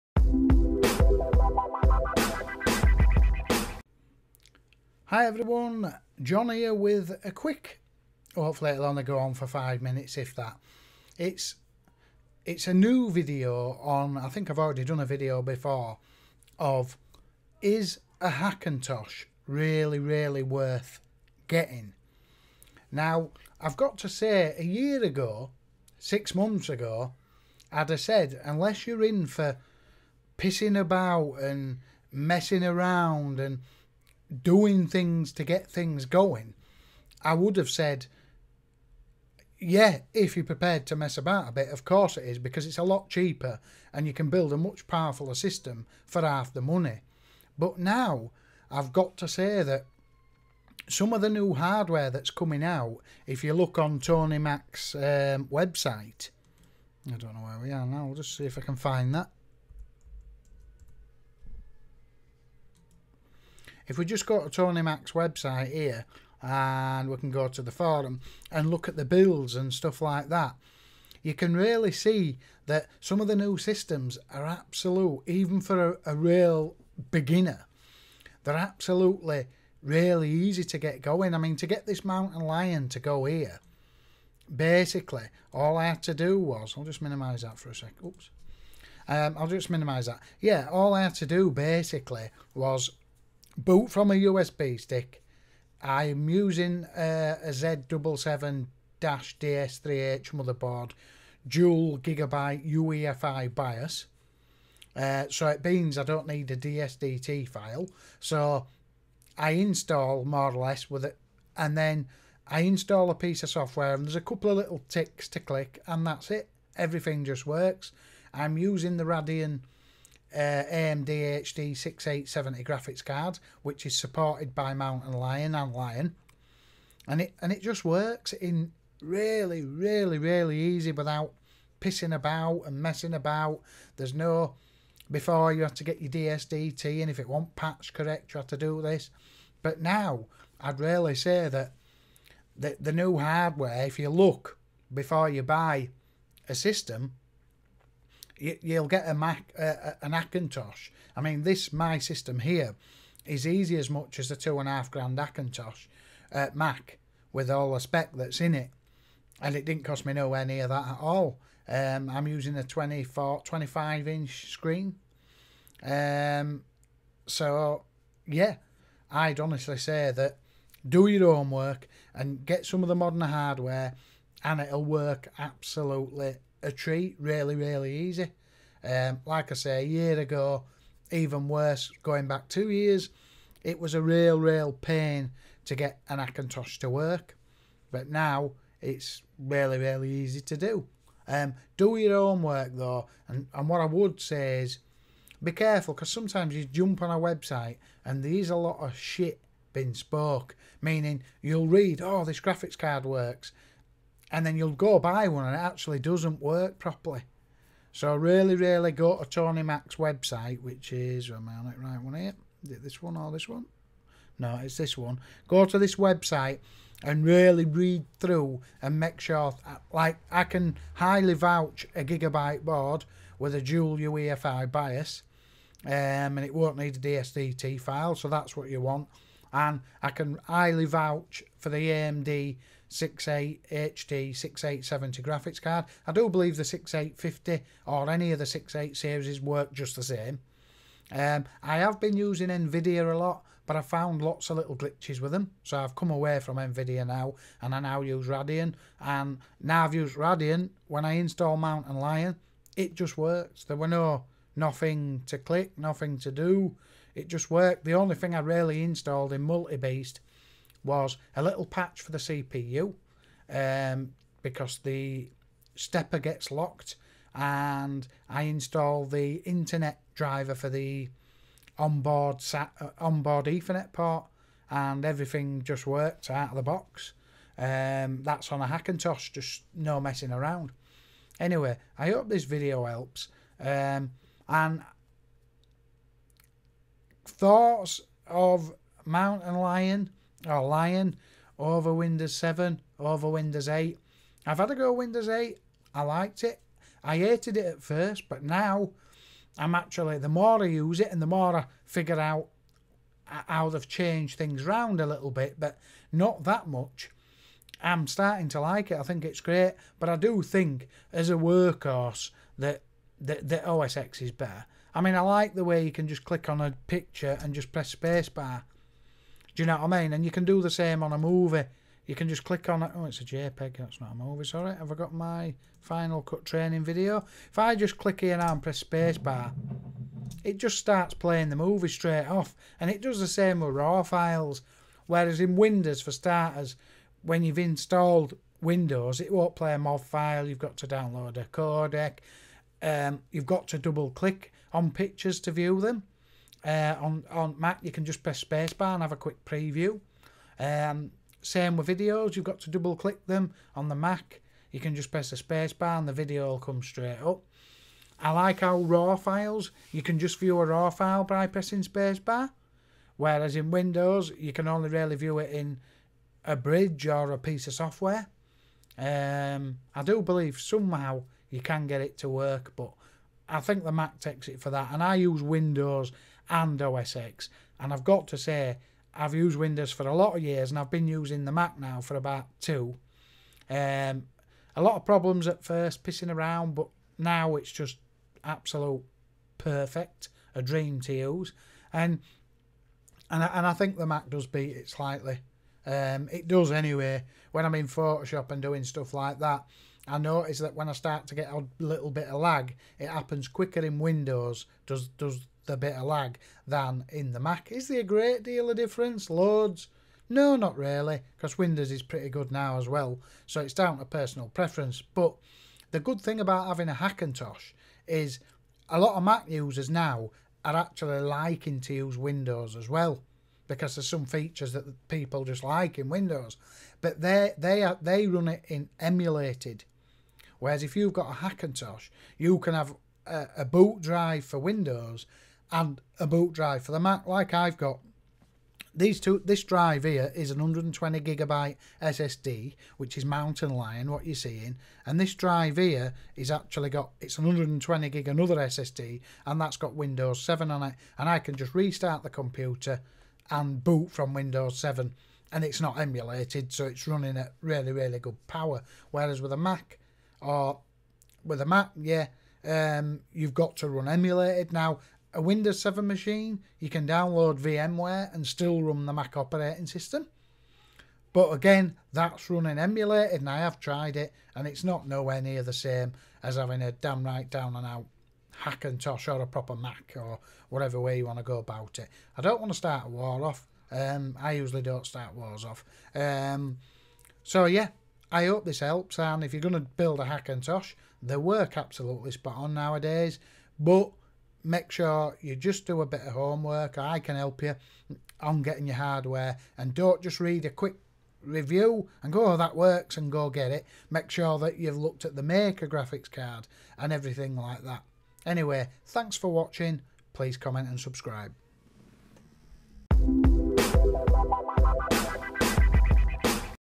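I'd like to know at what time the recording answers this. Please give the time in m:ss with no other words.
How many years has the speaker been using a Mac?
6:22.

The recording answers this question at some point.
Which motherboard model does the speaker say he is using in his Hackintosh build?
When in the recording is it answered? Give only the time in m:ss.
1:37.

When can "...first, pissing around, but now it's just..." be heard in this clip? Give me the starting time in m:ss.
6:25.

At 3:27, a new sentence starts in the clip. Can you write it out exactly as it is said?
So really, really go to Tony Mac's website, which is, am I on it right one here?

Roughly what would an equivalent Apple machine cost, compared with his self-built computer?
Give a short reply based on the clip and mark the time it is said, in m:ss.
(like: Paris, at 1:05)
two and a half grand, at 2:34.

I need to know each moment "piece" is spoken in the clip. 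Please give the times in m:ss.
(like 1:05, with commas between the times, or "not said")
1:53, 6:07.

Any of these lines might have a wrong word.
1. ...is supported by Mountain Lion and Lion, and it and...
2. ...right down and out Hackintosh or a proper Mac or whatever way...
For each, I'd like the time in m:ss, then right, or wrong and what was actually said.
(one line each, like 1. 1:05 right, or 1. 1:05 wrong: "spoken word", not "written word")
1. 2:03 right
2. 7:57 right.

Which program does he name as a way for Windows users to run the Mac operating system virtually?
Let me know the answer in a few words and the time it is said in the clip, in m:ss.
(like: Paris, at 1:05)
VMware, at 7:47.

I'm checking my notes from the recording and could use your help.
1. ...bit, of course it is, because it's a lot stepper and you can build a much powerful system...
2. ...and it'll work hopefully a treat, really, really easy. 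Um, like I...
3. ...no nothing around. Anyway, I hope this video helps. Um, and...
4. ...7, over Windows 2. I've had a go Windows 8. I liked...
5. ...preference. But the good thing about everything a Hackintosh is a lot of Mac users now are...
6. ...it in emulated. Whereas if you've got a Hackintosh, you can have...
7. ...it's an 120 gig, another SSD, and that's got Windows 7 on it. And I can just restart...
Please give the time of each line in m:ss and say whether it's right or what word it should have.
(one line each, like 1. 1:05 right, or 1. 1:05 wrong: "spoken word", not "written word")
1. 0:41 wrong: "cheaper", not "stepper"
2. 2:54 wrong: "absolutely", not "hopefully"
3. 4:39 wrong: "messing", not "nothing"
4. 4:52 wrong: "8", not "2"
5. 6:54 wrong: "having", not "everything"
6. 7:08 right
7. 7:27 right.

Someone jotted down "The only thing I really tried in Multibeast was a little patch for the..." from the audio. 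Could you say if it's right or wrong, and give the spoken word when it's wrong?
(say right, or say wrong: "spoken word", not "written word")
wrong: "installed", not "tried".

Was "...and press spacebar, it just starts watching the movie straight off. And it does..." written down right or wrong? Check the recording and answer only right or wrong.
wrong.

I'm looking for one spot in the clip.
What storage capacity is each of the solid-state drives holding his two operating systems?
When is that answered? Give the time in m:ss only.
7:20.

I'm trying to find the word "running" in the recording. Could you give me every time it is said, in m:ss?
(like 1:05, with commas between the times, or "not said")
7:37, 7:52.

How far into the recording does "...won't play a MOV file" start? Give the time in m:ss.
5:39.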